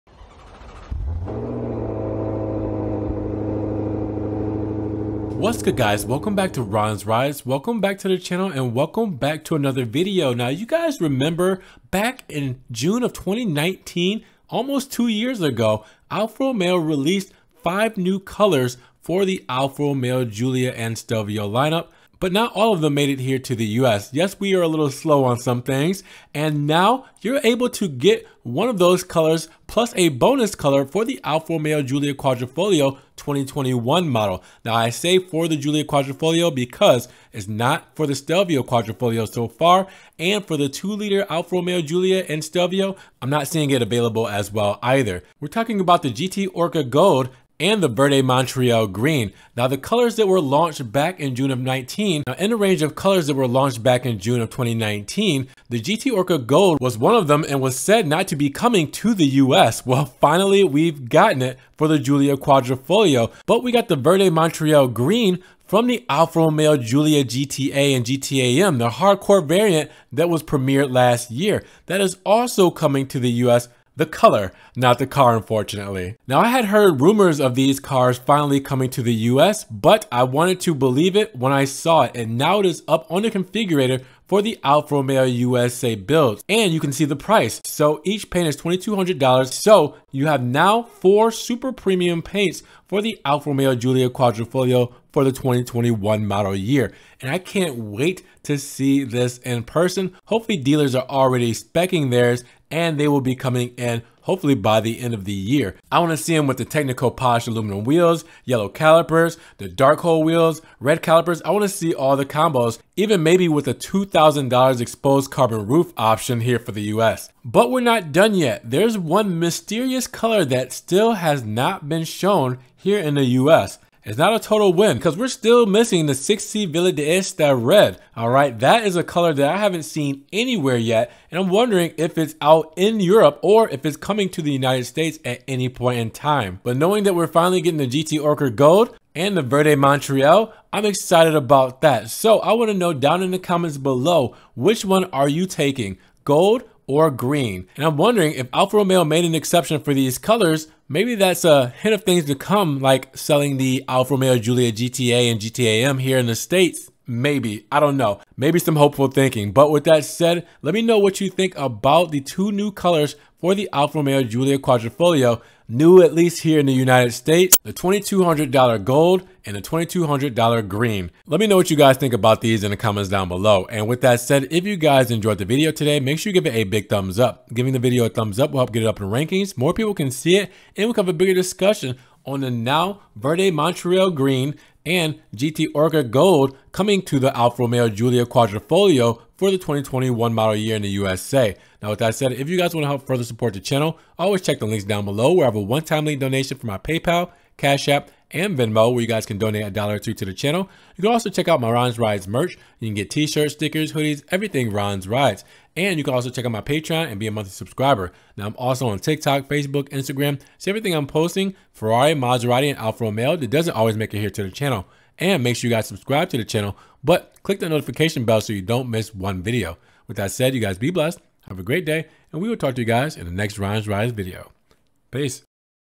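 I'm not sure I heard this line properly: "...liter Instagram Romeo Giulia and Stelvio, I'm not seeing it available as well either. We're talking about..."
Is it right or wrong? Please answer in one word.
wrong.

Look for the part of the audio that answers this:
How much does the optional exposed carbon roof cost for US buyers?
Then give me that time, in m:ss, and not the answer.
1:53.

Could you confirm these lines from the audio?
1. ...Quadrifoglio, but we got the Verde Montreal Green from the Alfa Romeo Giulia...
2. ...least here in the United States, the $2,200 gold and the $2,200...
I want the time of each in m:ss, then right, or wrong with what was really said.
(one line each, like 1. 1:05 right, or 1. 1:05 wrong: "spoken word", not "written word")
1. 1:02 right
2. 2:46 right.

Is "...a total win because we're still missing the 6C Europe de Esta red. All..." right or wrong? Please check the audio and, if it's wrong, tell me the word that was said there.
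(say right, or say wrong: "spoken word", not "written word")
wrong: "Villa", not "Europe".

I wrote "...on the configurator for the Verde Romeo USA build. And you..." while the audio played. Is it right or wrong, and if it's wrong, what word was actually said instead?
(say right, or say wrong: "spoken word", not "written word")
wrong: "Alfa", not "Verde".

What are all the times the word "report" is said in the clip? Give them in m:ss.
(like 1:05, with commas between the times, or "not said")
not said.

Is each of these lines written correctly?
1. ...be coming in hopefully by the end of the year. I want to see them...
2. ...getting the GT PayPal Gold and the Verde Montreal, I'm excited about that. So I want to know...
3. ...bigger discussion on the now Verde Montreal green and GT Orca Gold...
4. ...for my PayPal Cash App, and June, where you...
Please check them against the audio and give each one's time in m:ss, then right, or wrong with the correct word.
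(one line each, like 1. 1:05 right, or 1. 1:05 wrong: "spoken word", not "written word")
1. 1:43 right
2. 2:17 wrong: "Orca", not "PayPal"
3. 3:01 right
4. 3:16 wrong: "Venmo", not "June".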